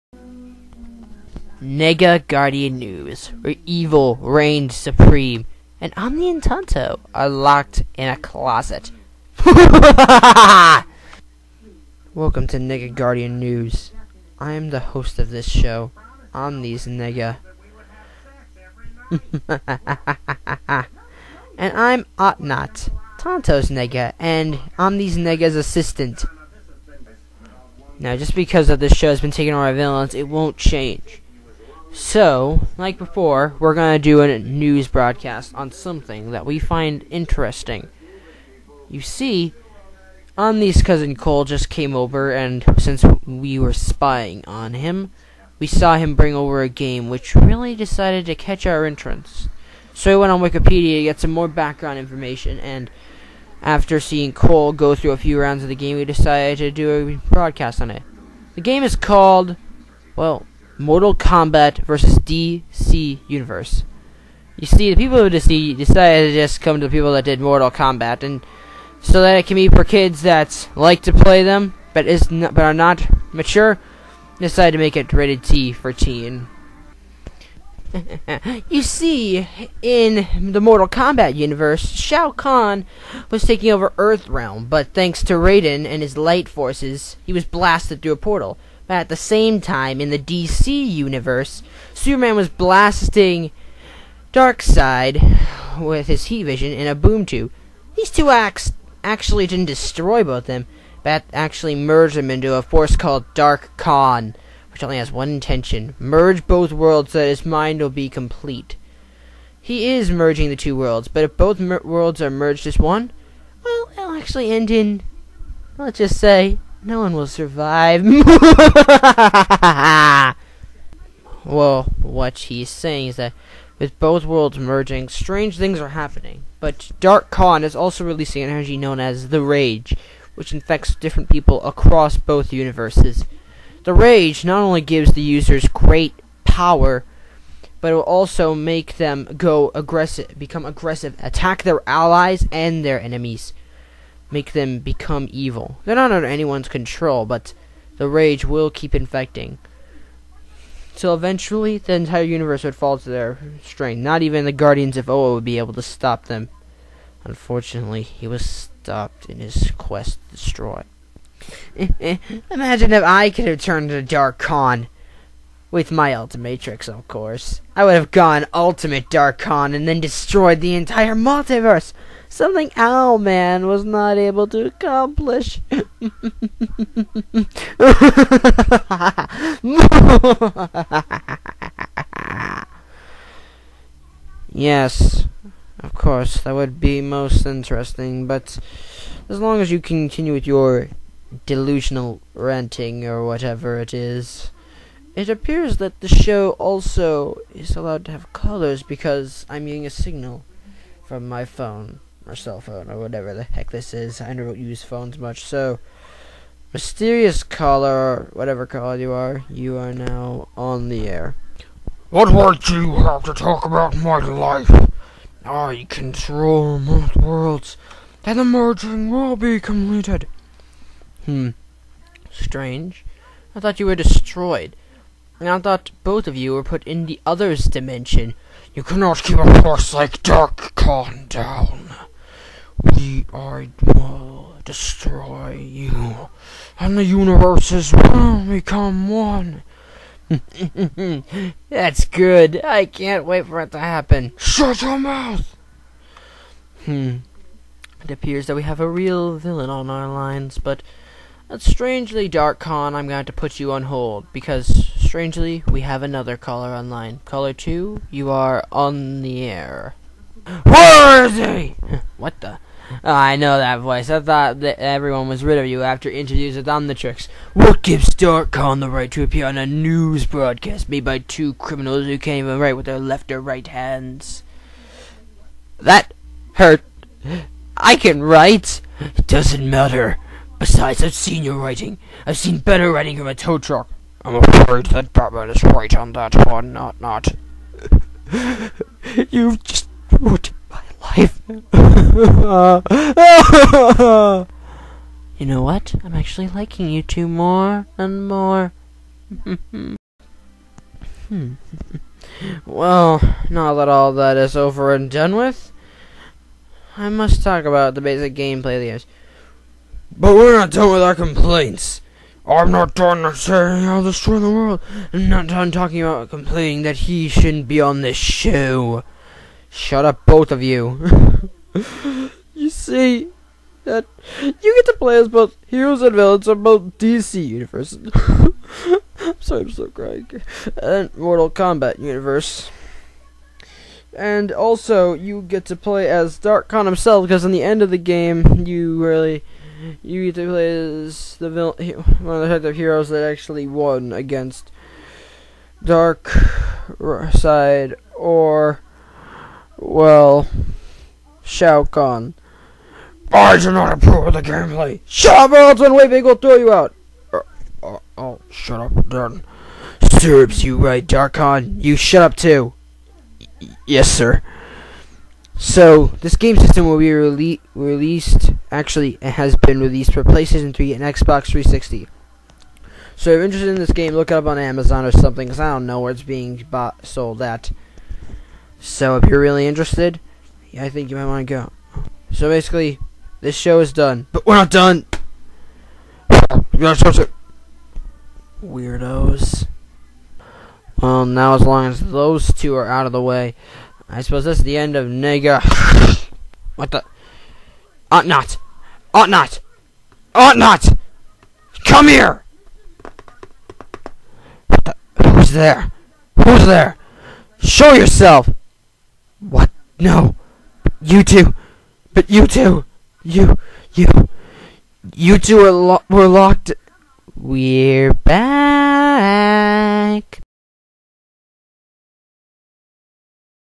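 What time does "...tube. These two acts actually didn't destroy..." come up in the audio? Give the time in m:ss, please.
1:37.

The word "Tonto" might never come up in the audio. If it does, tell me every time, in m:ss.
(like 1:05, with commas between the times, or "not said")
0:06, 0:23.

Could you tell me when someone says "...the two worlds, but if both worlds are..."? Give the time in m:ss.
1:50.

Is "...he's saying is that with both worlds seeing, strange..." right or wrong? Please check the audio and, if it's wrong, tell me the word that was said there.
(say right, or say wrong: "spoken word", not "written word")
wrong: "merging", not "seeing".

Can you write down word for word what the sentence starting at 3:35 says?
I control most worlds, and the merging will be completed.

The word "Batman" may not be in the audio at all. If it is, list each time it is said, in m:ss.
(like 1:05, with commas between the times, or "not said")
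4:45.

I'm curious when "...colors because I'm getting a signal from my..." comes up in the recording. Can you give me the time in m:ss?
3:18.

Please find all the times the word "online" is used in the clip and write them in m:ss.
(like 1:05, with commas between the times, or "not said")
4:16.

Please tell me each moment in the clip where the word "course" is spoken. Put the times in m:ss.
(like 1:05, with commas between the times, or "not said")
2:47, 3:05.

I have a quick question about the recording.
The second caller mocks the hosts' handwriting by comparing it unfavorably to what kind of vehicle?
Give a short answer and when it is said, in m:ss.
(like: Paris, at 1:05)
A tow truck, at 4:43.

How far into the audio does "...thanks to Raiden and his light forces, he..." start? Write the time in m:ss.
1:24.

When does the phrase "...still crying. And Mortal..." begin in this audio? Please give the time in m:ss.
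5:29.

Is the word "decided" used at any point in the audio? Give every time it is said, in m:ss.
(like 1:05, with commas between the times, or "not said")
0:47, 0:56, 1:05, 1:14.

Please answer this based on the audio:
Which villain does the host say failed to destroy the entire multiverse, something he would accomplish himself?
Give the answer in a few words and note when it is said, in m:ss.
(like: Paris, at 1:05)
Owlman, at 2:52.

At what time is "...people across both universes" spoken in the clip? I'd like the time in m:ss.
2:11.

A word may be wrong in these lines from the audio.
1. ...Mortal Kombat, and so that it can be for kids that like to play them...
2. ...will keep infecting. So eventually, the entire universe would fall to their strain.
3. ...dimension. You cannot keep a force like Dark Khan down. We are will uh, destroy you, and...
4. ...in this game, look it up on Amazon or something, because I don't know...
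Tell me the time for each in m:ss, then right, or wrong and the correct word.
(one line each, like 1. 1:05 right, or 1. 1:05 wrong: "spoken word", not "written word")
1. 1:07 right
2. 2:28 right
3. 3:47 right
4. 6:13 right.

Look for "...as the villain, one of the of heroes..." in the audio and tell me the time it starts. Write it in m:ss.
5:41.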